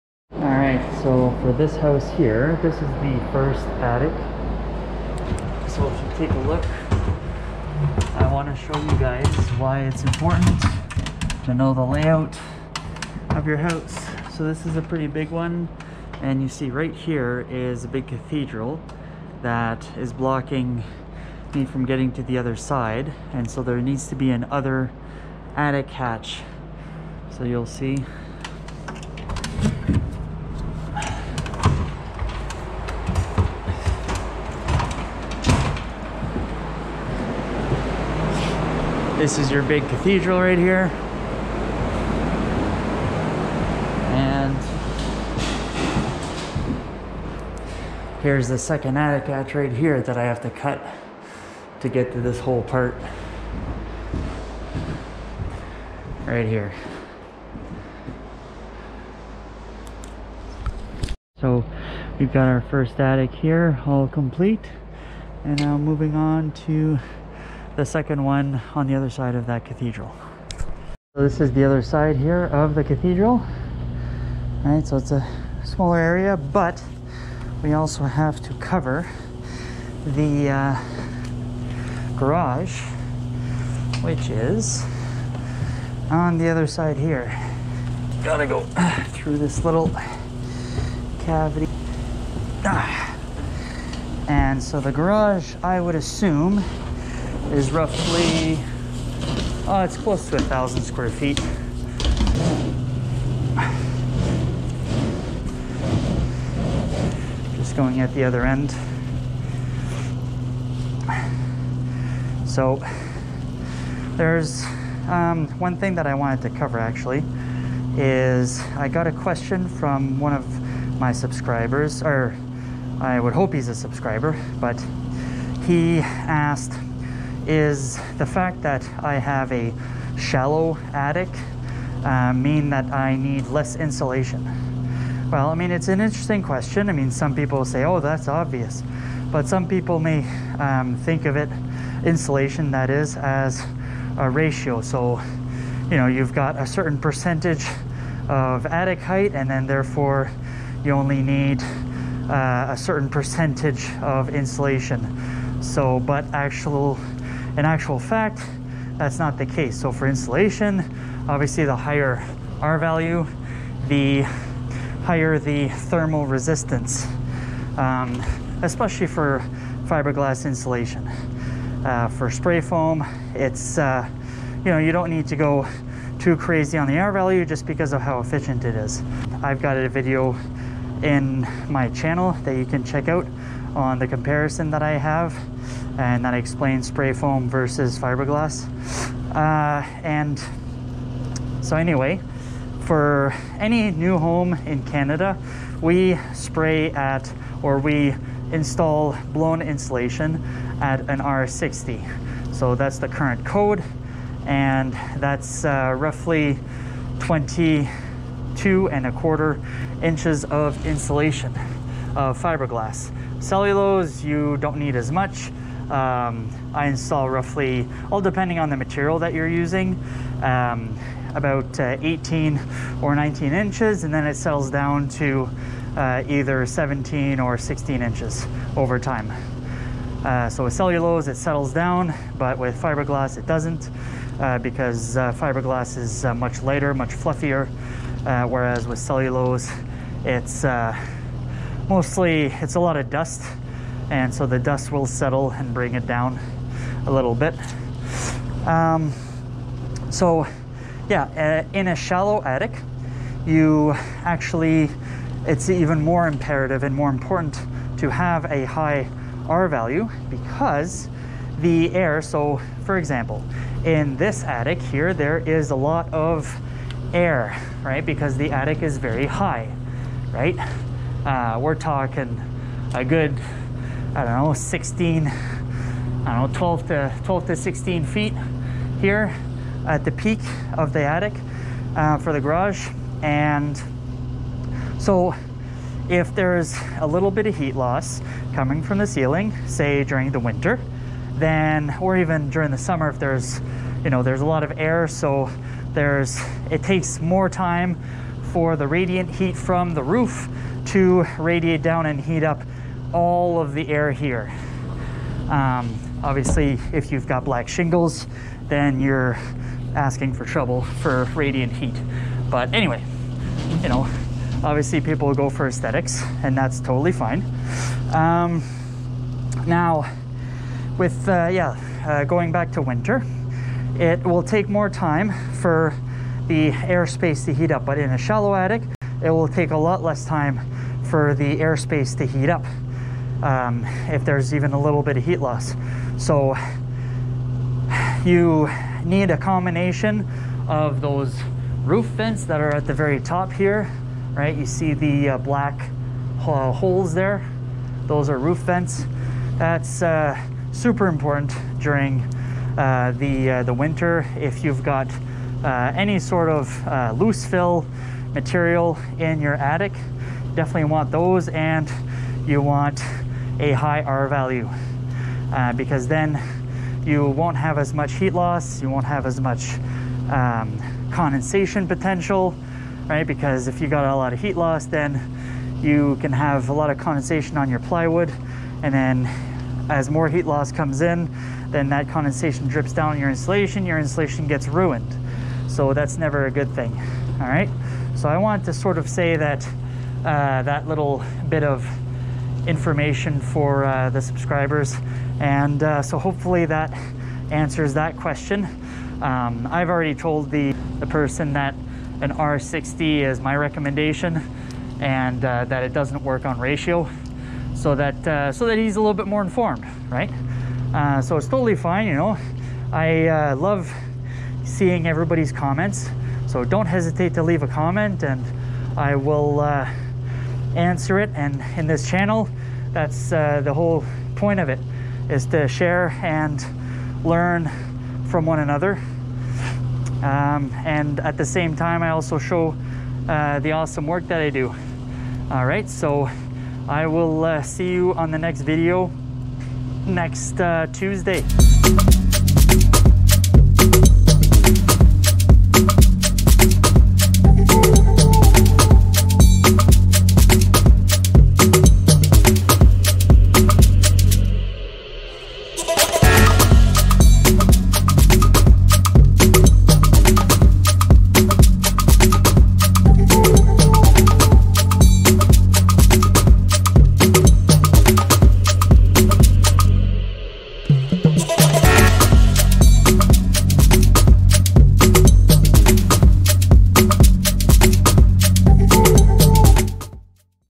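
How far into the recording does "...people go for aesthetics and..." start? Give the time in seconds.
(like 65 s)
315 s.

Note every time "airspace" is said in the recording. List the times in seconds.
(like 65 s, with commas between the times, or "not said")
326 s, 331 s.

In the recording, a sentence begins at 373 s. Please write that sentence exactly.
Because if you got a lot of heat loss, then you can have a lot of condensation on your plywood.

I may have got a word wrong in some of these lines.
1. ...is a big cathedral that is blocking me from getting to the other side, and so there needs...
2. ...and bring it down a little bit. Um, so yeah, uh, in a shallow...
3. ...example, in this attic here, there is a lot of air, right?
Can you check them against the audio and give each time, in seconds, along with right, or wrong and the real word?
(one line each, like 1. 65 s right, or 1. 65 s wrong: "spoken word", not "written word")
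1. 17 s right
2. 245 s right
3. 262 s right.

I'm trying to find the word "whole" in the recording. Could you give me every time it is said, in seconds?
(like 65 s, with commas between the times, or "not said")
52 s, 423 s.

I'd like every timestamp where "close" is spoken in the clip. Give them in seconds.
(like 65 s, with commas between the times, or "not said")
99 s.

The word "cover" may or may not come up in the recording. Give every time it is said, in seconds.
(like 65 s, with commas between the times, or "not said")
78 s, 116 s.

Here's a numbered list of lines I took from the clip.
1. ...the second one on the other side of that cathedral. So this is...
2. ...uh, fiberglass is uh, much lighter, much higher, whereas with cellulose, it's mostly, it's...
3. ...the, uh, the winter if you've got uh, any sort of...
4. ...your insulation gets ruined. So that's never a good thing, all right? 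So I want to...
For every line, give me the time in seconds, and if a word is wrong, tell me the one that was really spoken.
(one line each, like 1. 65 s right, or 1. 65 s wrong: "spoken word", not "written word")
1. 67 s right
2. 235 s wrong: "fluffier", not "higher"
3. 353 s right
4. 383 s right.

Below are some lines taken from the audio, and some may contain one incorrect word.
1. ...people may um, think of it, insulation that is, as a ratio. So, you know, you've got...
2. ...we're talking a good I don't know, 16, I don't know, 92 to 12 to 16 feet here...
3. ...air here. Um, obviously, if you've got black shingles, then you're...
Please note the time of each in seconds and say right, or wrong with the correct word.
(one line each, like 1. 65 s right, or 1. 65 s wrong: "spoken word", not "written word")
1. 139 s right
2. 271 s wrong: "12", not "92"
3. 303 s right.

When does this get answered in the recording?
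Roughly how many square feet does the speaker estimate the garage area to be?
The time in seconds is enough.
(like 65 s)
100 s.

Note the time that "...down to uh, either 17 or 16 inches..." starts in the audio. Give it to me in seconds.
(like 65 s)
224 s.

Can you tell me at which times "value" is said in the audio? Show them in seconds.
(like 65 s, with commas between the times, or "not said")
162 s, 177 s, 259 s, 364 s.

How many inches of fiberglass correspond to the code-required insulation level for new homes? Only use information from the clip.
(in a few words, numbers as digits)
22 and a quarter inches.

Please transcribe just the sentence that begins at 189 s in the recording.
Uh, and so, anyway, for any new home in Canada, we spray at or we install blown insulation at an R60.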